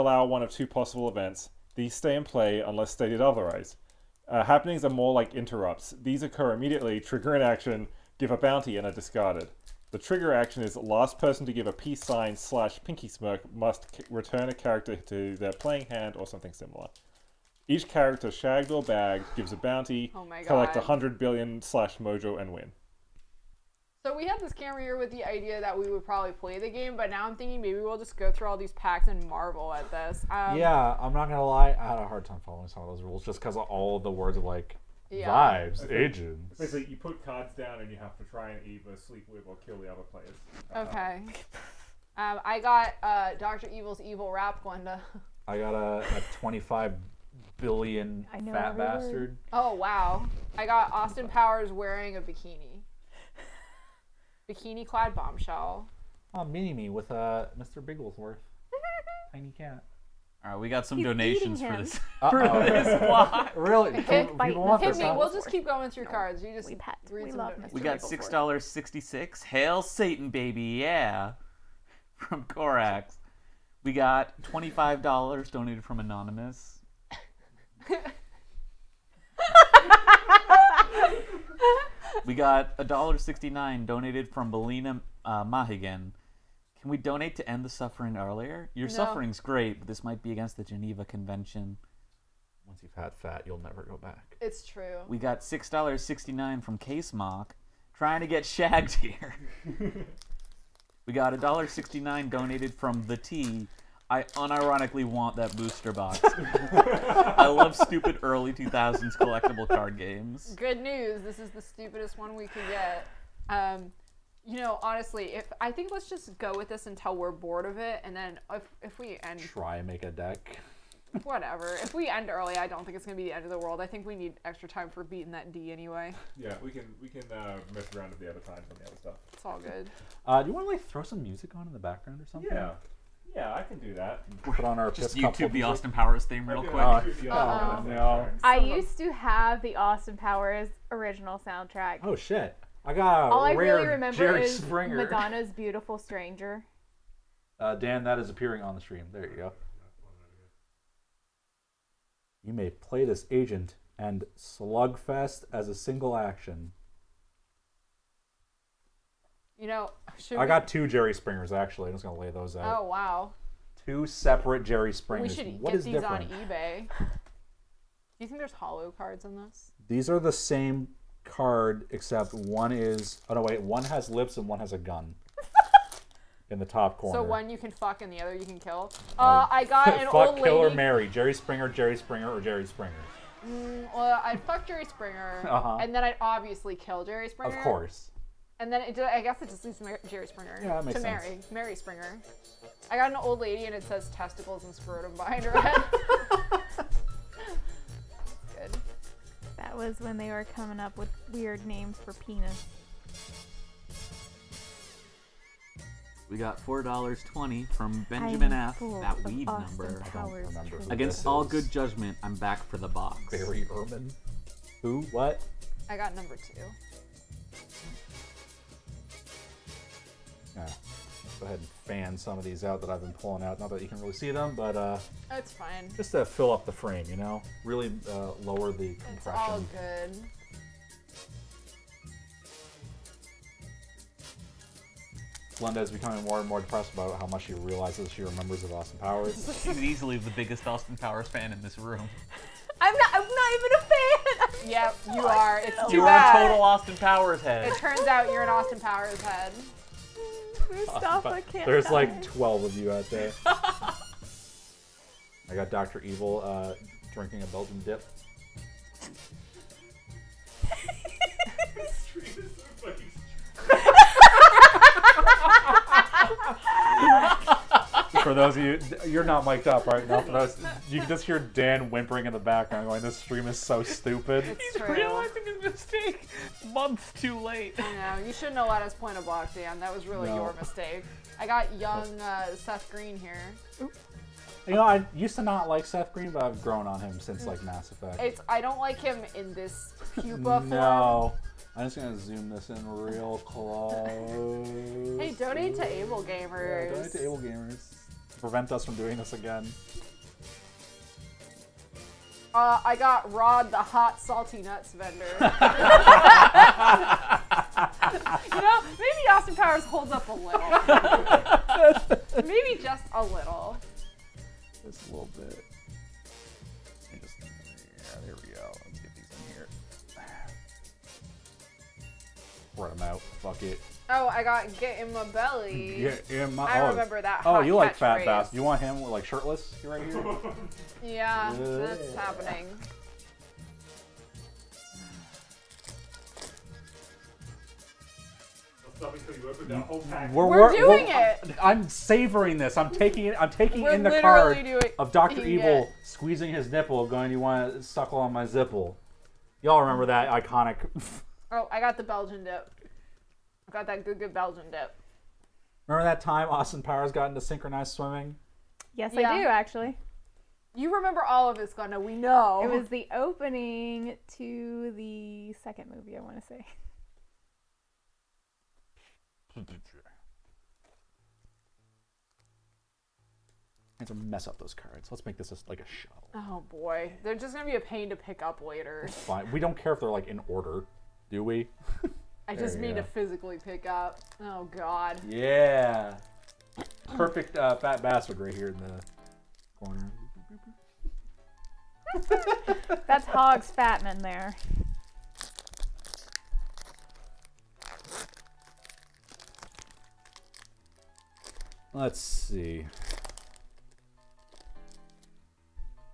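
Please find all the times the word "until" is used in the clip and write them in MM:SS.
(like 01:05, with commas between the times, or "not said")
01:56.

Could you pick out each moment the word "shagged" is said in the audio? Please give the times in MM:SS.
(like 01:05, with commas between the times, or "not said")
00:18, 01:38.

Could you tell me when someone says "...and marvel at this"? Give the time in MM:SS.
00:29.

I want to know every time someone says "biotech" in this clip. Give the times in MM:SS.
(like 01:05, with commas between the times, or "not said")
not said.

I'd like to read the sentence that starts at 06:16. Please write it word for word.
Oh boy, they're just gonna be a pain to pick up later.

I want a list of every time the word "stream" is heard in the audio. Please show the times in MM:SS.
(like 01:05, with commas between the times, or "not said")
02:28, 04:33.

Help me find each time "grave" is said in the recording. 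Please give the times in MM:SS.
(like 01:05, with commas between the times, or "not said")
not said.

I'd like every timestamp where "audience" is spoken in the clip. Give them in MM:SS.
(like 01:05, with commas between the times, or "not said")
not said.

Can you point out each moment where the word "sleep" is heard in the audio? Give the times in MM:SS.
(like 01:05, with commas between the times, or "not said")
00:38.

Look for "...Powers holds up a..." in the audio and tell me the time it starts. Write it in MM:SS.
05:09.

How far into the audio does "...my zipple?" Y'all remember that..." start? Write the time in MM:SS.
05:48.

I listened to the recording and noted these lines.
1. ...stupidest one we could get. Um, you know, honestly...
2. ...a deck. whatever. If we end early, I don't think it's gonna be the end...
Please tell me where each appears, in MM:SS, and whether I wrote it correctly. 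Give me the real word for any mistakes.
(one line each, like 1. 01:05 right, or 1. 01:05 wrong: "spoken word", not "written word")
1. 01:51 right
2. 02:00 right.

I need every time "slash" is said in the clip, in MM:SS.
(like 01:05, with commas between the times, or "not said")
00:12, 00:21.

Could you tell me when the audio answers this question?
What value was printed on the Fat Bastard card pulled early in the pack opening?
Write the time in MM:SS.
00:46.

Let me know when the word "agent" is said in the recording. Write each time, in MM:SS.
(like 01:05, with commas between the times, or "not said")
00:36, 02:33.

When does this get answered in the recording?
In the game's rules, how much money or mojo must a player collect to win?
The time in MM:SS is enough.
00:20.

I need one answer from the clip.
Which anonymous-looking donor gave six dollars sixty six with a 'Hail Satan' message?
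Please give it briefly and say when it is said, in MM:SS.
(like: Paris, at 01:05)
Korax, at 01:12.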